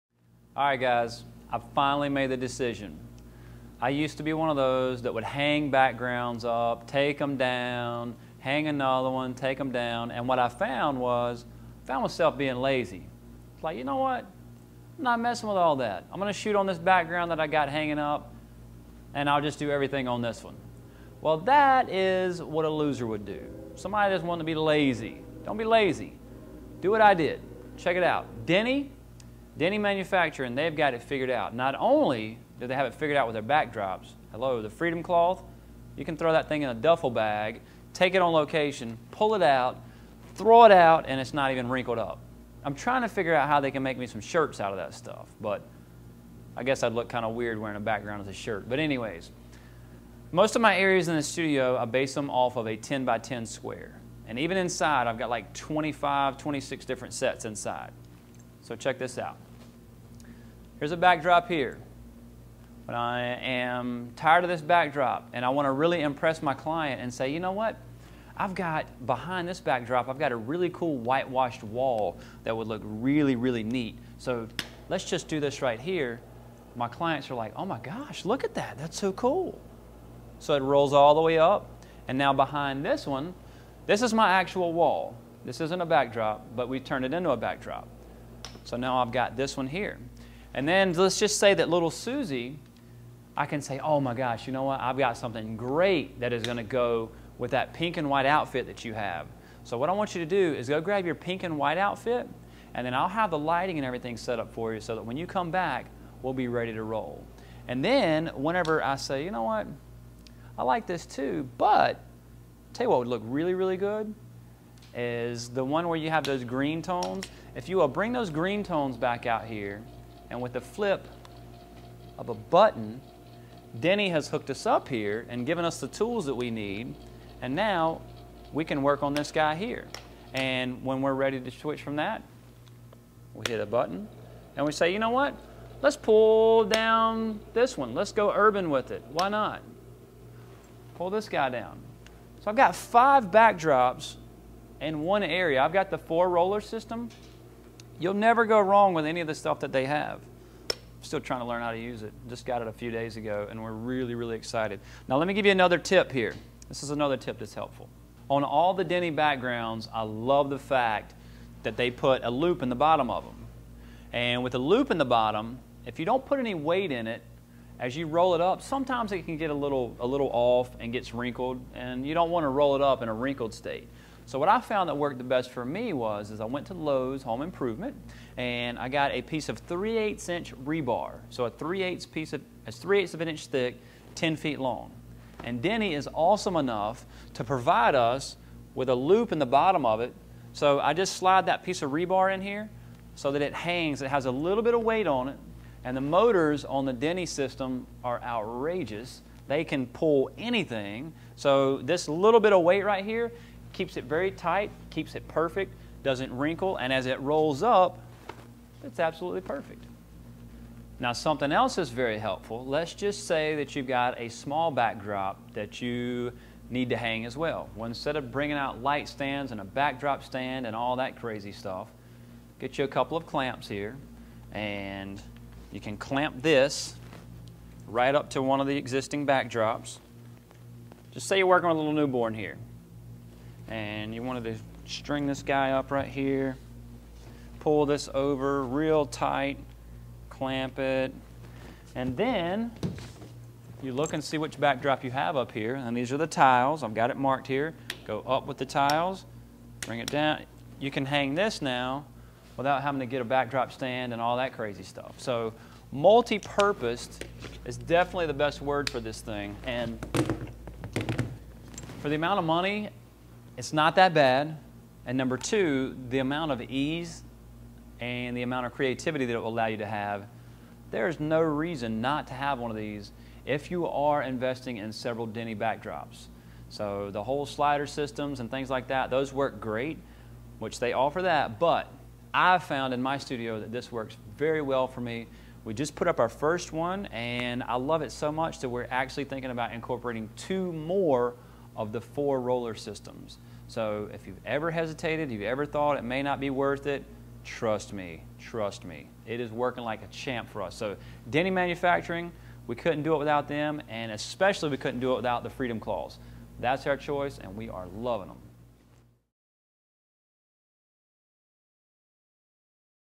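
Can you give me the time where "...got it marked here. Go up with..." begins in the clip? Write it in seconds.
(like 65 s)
246 s.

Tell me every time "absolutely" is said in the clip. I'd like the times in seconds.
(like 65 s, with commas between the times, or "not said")
208 s.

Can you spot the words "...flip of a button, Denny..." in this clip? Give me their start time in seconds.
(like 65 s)
120 s.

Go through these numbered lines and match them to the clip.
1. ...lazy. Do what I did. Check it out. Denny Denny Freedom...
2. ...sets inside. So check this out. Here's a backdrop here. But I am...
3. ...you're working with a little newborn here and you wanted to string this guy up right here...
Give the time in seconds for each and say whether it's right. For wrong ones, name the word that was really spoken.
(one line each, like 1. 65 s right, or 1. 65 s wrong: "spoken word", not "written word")
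1. 25 s wrong: "Manufacturing", not "Freedom"
2. 57 s right
3. 231 s right.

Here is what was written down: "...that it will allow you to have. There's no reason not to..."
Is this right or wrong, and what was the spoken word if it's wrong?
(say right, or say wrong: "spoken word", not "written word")
right.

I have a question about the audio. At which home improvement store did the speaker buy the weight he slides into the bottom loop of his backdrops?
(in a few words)
Lowe's.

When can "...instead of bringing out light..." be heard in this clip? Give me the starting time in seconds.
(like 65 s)
217 s.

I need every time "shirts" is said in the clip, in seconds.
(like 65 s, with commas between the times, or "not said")
44 s, 48 s.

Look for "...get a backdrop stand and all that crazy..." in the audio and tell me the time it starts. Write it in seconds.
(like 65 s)
253 s.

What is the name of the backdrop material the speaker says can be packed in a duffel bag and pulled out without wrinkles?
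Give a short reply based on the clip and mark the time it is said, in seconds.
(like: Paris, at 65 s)
Freedom Cloth, at 34 s.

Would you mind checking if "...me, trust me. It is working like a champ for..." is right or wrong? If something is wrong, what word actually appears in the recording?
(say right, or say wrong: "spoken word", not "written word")
right.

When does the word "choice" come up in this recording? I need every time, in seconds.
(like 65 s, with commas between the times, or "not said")
306 s.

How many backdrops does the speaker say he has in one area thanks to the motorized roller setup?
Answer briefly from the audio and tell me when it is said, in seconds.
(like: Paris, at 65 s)
5, at 142 s.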